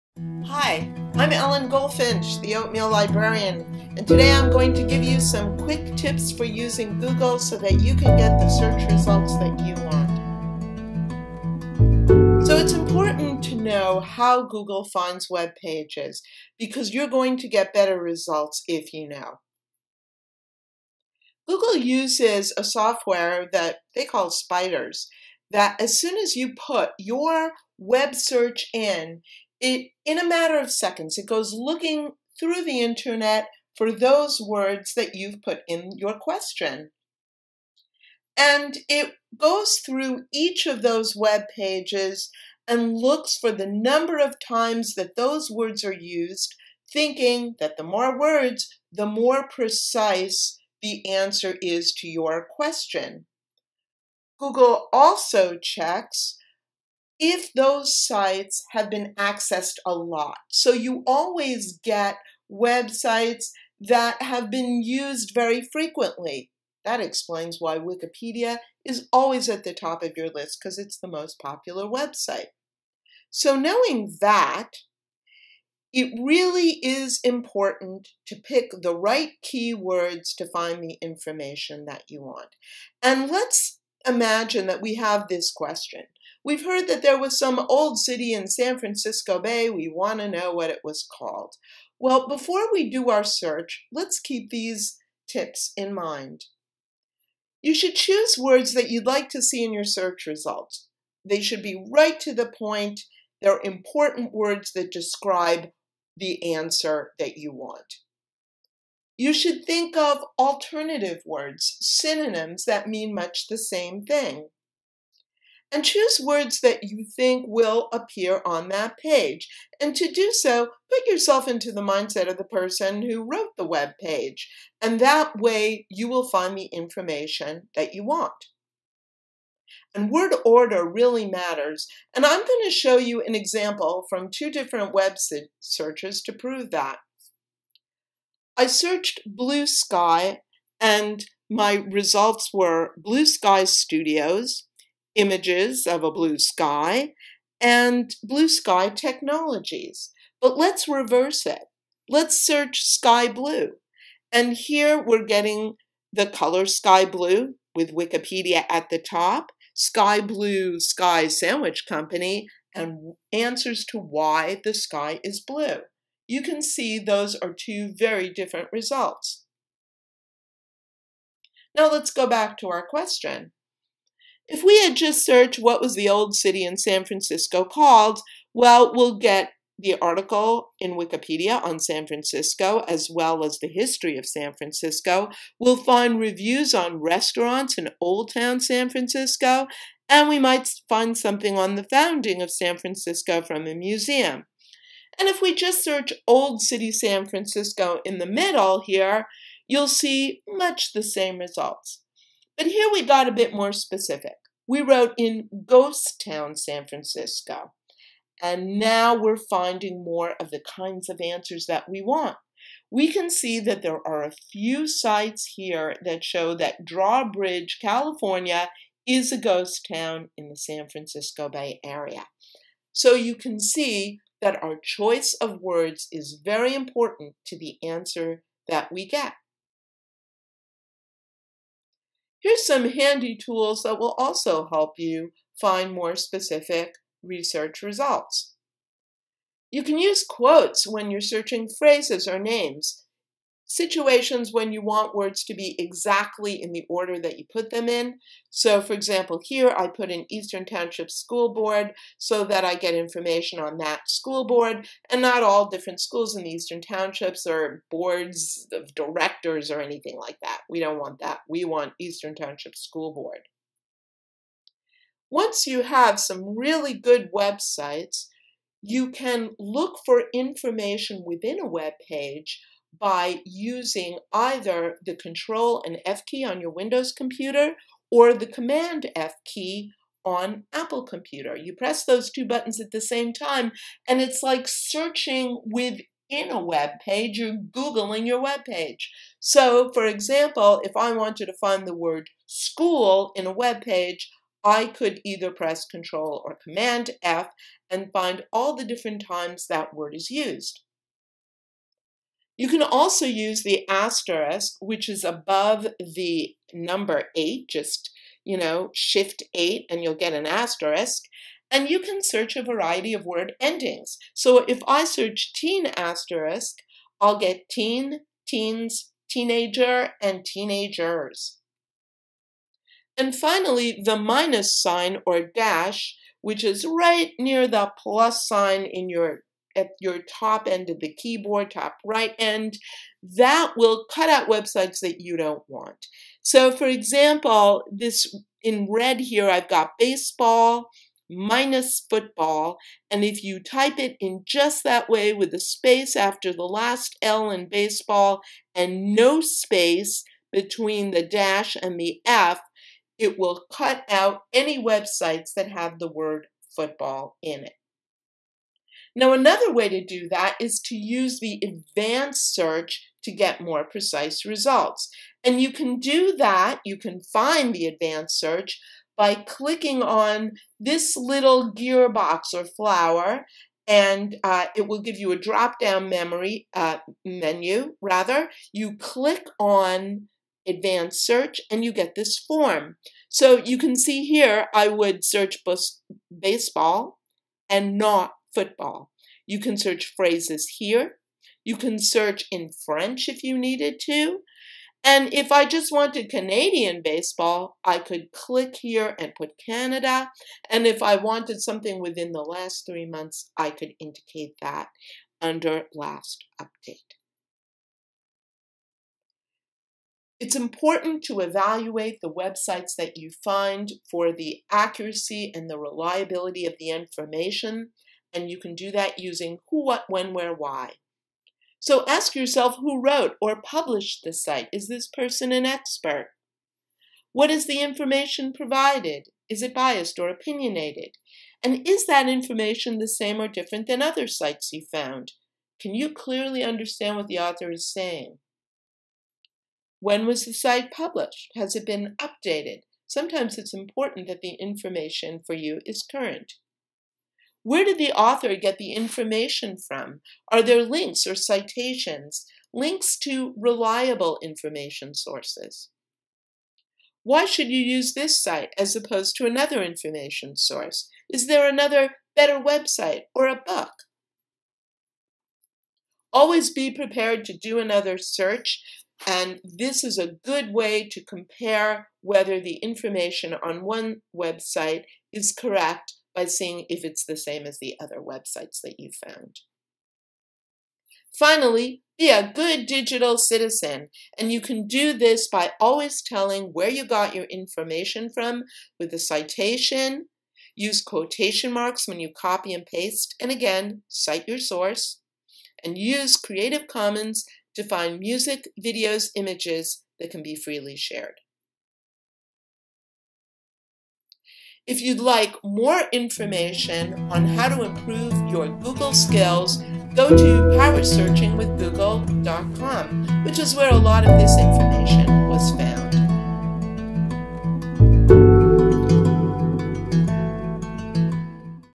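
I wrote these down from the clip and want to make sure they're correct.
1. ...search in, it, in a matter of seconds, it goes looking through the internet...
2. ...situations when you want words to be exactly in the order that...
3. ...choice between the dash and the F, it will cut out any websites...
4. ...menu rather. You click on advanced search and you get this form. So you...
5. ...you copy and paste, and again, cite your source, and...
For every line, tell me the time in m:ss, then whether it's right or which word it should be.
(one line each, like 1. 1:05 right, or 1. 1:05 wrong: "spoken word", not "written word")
1. 0:28 right
2. 4:03 right
3. 5:49 wrong: "space", not "choice"
4. 6:17 right
5. 8:12 right.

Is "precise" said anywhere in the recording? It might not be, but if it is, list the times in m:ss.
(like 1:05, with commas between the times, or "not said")
0:49, 6:03.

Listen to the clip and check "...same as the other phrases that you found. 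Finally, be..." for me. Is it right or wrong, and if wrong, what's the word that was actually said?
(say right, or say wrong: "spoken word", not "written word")
wrong: "websites", not "phrases".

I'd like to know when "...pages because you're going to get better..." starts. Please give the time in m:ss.
0:15.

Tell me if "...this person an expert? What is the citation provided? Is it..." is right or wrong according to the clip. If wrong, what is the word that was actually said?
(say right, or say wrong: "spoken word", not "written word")
wrong: "information", not "citation".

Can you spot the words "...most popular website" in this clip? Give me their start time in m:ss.
1:11.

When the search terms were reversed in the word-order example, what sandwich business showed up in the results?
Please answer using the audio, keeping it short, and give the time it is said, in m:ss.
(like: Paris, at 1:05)
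Sky Blue Sky Sandwich Company, at 2:39.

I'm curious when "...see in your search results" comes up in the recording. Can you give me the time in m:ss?
1:39.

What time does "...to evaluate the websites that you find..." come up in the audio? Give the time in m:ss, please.
6:51.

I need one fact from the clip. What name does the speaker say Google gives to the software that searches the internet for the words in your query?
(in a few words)
Spiders.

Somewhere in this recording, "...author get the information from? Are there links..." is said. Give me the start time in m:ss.
7:28.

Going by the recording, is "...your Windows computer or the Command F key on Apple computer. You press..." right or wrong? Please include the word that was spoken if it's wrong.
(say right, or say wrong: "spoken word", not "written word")
right.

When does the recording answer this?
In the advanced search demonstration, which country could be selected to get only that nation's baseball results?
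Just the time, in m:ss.
6:39.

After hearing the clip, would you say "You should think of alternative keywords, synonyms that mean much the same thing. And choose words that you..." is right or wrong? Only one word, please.
wrong.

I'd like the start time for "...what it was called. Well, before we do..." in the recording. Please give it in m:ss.
1:30.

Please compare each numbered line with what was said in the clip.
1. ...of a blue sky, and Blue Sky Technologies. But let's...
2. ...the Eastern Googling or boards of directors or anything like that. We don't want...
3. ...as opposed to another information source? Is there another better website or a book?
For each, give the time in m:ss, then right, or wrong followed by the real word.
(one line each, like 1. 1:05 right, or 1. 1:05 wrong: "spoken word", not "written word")
1. 2:25 right
2. 4:16 wrong: "Townships", not "Googling"
3. 7:38 right.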